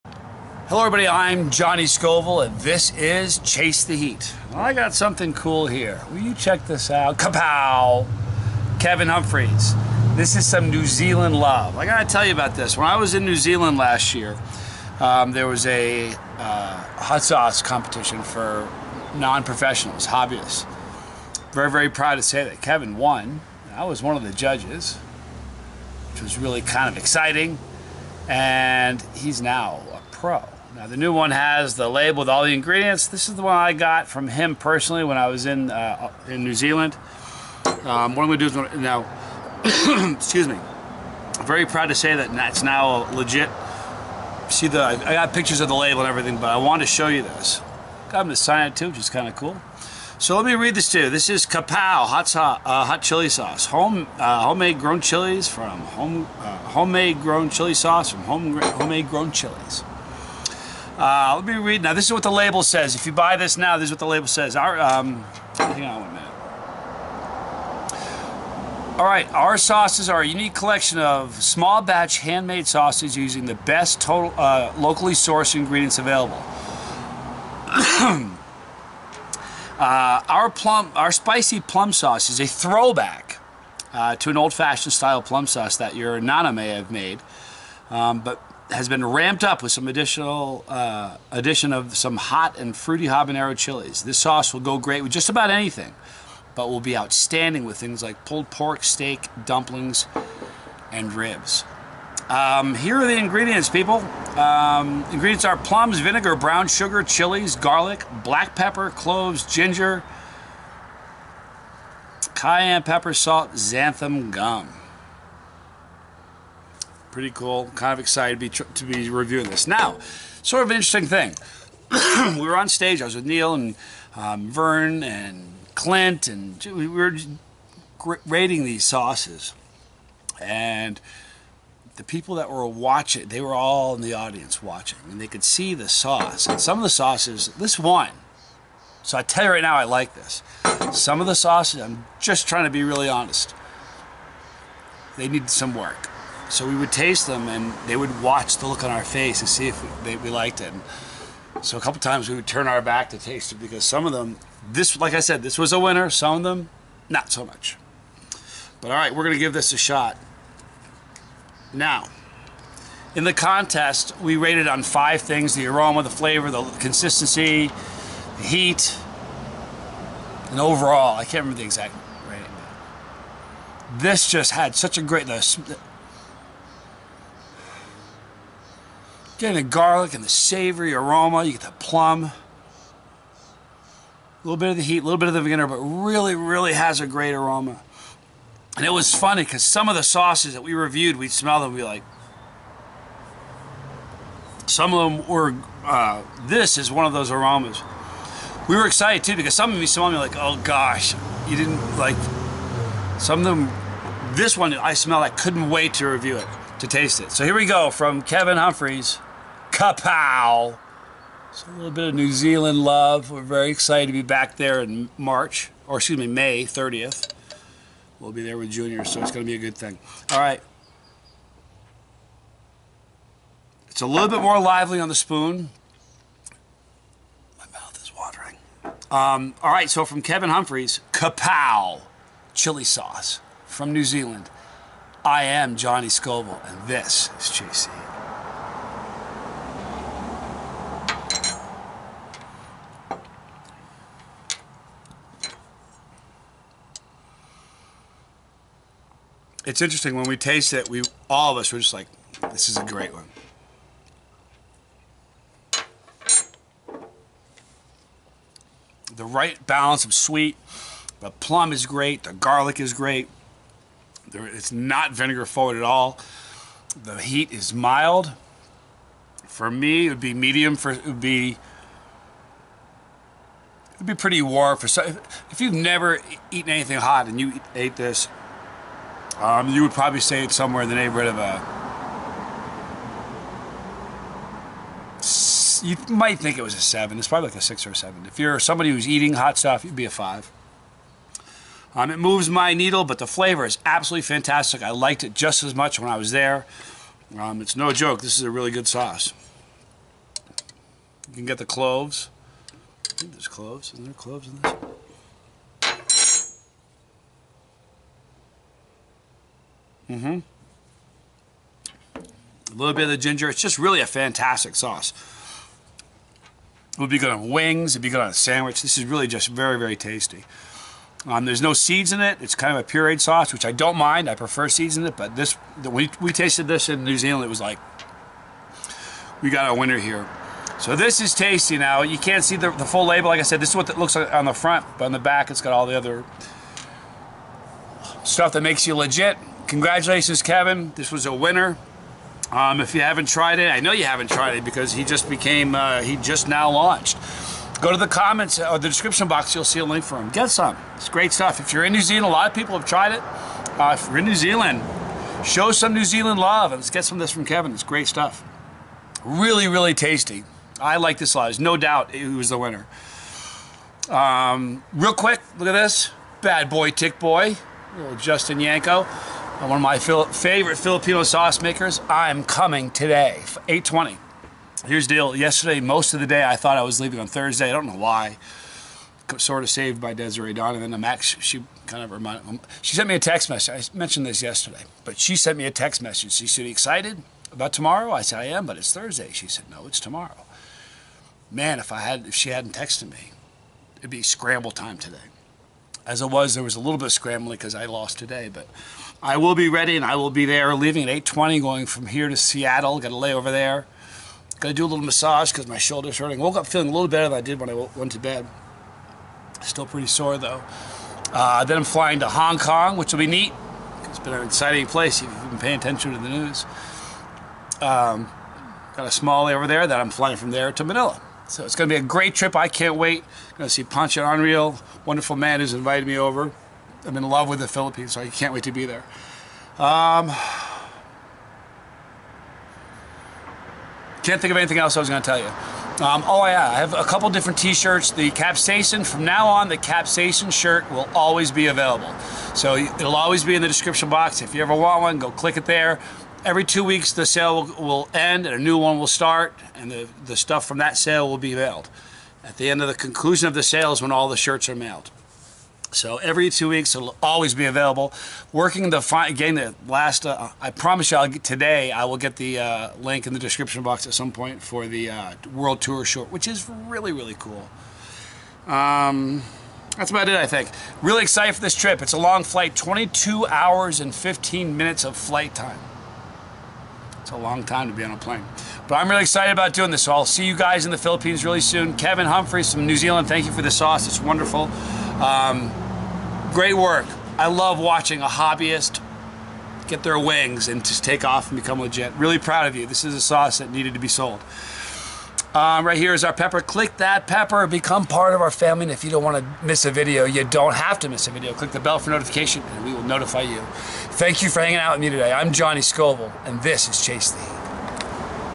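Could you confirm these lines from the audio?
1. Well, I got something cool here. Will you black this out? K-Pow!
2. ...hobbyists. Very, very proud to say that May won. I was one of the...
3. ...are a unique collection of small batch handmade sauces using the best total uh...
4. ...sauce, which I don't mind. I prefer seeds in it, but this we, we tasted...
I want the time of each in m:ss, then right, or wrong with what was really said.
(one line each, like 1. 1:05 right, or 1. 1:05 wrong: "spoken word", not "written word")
1. 0:04 wrong: "check", not "black"
2. 0:20 wrong: "Kevan", not "May"
3. 1:10 right
4. 5:23 right.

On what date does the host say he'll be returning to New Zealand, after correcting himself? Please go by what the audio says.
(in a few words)
May 30th.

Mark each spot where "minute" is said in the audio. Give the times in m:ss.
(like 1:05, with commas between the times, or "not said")
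1:06, 7:54.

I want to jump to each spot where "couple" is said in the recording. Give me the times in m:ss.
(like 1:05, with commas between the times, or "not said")
2:31, 7:17.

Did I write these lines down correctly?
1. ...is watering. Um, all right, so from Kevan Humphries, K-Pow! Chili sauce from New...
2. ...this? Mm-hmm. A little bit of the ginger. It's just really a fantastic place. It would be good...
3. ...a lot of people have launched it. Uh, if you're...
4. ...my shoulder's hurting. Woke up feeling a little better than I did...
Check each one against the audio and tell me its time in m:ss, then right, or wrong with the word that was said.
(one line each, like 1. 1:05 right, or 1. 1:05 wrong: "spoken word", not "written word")
1. 3:48 right
2. 5:04 wrong: "sauce", not "place"
3. 5:52 wrong: "tried", not "launched"
4. 6:45 right.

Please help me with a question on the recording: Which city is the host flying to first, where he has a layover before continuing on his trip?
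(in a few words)
Seattle.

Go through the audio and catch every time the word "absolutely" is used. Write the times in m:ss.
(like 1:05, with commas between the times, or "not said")
4:53.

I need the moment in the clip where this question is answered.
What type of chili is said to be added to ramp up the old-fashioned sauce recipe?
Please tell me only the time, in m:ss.
1:33.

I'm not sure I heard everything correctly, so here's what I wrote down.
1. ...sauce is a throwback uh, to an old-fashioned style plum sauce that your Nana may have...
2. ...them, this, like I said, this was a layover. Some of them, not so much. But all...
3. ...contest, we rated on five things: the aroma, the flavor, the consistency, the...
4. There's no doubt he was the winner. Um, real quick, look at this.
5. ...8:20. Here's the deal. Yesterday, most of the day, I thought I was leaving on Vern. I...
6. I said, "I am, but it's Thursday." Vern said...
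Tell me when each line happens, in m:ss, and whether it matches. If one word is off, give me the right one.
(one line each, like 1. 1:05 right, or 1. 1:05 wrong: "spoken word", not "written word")
1. 1:21 right
2. 2:34 wrong: "winner", not "layover"
3. 2:43 right
4. 6:01 right
5. 6:13 wrong: "Thursday", not "Vern"
6. 6:28 wrong: "She", not "Vern".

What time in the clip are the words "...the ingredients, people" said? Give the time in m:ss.
1:43.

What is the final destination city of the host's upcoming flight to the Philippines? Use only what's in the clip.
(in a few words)
Manila.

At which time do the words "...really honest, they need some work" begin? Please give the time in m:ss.
2:22.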